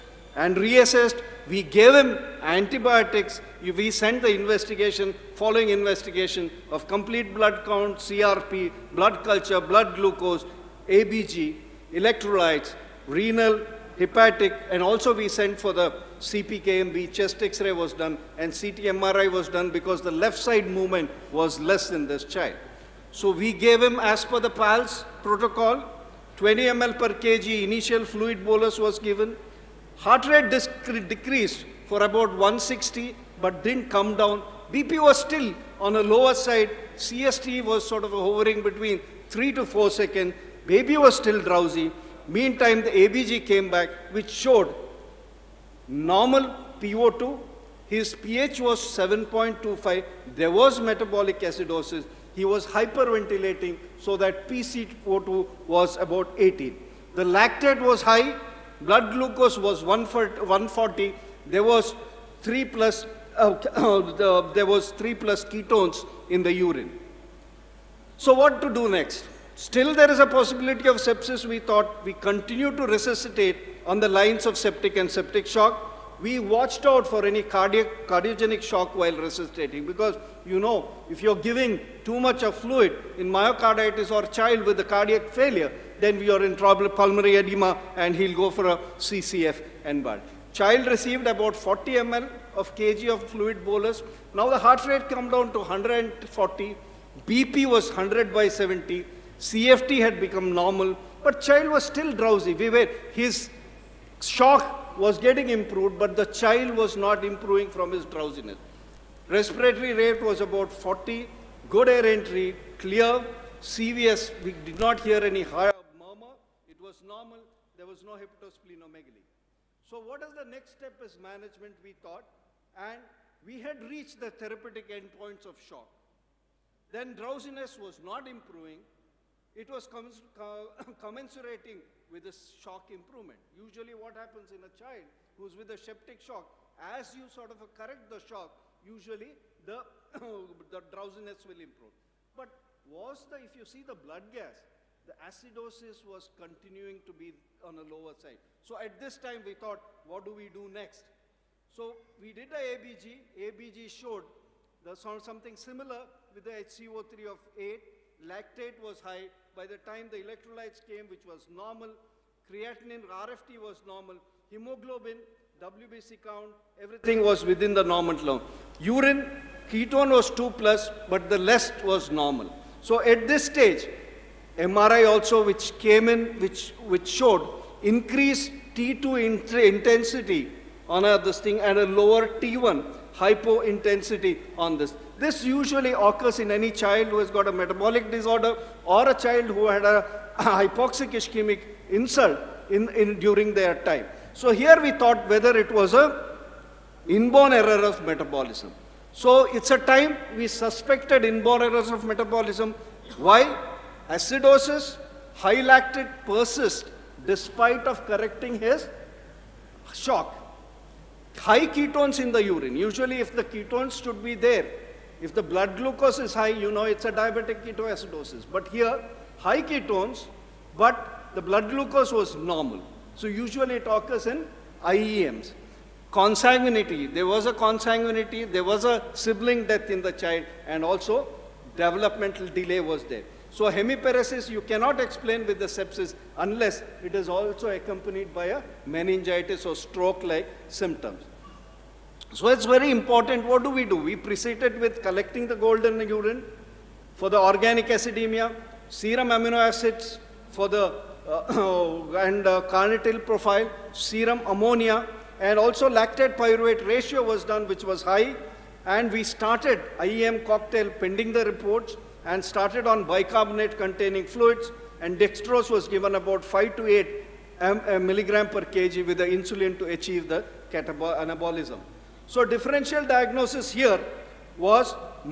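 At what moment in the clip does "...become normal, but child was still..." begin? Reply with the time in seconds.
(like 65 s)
100 s.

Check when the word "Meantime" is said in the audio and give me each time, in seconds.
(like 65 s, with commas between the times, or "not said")
42 s.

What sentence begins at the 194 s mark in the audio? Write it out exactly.
So here we thought whether it was a inborn error of metabolism.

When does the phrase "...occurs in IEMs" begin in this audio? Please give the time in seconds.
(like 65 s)
223 s.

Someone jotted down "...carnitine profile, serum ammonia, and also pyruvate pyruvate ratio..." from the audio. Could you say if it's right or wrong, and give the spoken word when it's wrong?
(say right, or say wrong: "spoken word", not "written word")
wrong: "lactate", not "pyruvate".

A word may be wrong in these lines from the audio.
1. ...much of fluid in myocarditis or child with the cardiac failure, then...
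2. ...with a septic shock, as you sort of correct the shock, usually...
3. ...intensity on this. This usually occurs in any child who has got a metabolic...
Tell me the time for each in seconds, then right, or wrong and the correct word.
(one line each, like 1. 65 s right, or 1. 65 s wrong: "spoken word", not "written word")
1. 82 s right
2. 135 s right
3. 183 s right.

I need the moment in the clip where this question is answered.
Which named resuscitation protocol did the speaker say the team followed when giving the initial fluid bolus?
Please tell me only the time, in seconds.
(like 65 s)
24 s.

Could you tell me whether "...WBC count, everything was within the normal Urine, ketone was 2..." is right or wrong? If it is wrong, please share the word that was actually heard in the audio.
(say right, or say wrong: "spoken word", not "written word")
right.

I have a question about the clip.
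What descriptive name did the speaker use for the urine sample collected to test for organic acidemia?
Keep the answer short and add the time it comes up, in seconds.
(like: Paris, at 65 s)
golden urine, at 245 s.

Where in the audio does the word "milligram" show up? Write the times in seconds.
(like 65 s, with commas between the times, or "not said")
267 s.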